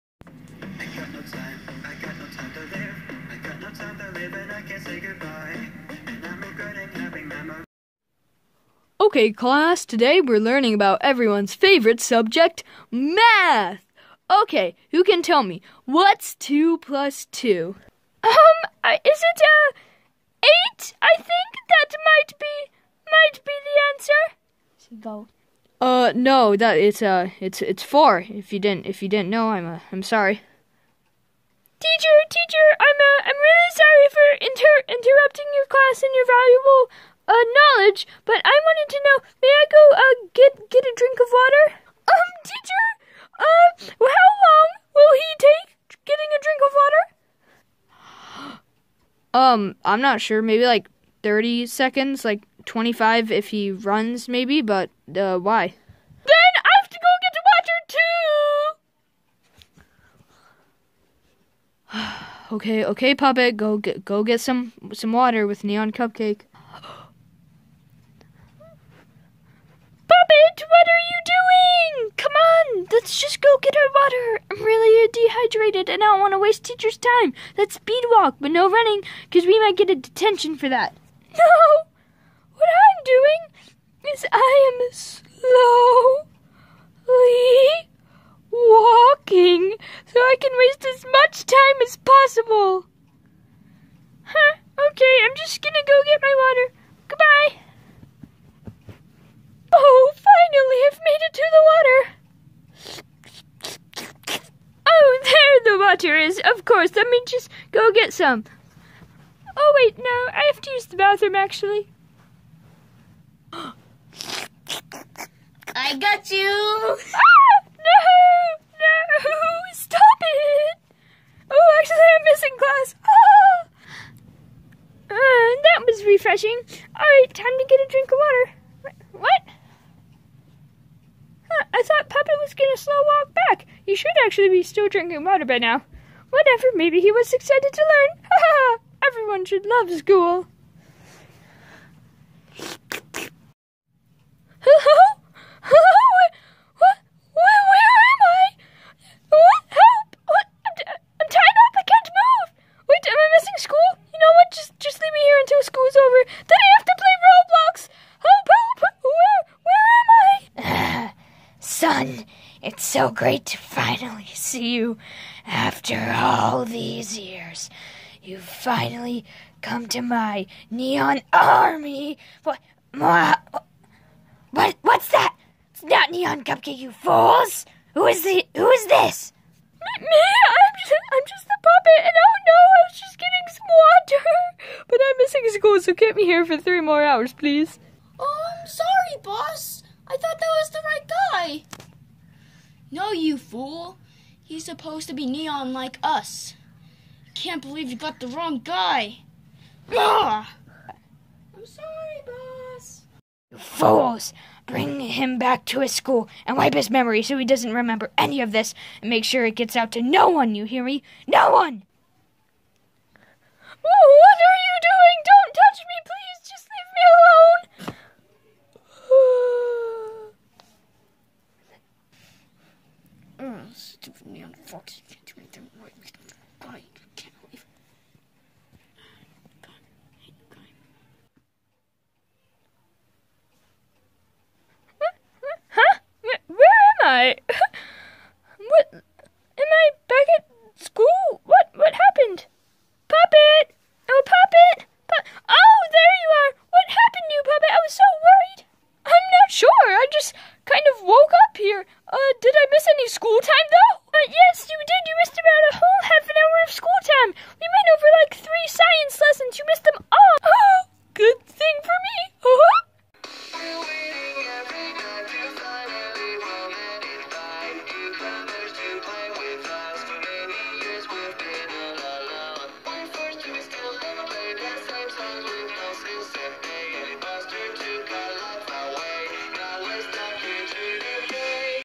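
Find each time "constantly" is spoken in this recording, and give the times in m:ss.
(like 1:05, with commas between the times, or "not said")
not said.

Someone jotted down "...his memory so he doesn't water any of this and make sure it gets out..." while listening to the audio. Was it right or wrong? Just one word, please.
wrong.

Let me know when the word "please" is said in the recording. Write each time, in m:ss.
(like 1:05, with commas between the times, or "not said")
3:07, 3:36.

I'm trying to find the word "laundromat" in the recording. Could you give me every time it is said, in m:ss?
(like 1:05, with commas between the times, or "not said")
not said.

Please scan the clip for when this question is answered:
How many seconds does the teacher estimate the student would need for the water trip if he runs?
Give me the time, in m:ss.
0:52.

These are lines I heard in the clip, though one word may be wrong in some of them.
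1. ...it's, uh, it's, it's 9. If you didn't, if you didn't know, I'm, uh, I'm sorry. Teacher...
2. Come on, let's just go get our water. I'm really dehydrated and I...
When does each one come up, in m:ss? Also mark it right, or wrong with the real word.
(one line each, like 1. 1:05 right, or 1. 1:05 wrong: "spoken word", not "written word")
1. 0:26 wrong: "4", not "9"
2. 1:12 right.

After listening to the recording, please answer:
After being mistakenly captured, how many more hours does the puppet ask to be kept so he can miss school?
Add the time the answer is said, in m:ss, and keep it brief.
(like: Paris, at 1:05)
3, at 3:06.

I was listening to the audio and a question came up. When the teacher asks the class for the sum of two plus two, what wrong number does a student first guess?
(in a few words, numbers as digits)
8.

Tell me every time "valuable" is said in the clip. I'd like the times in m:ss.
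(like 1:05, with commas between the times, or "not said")
0:36.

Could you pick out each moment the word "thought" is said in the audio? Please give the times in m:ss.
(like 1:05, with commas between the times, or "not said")
2:11, 3:10.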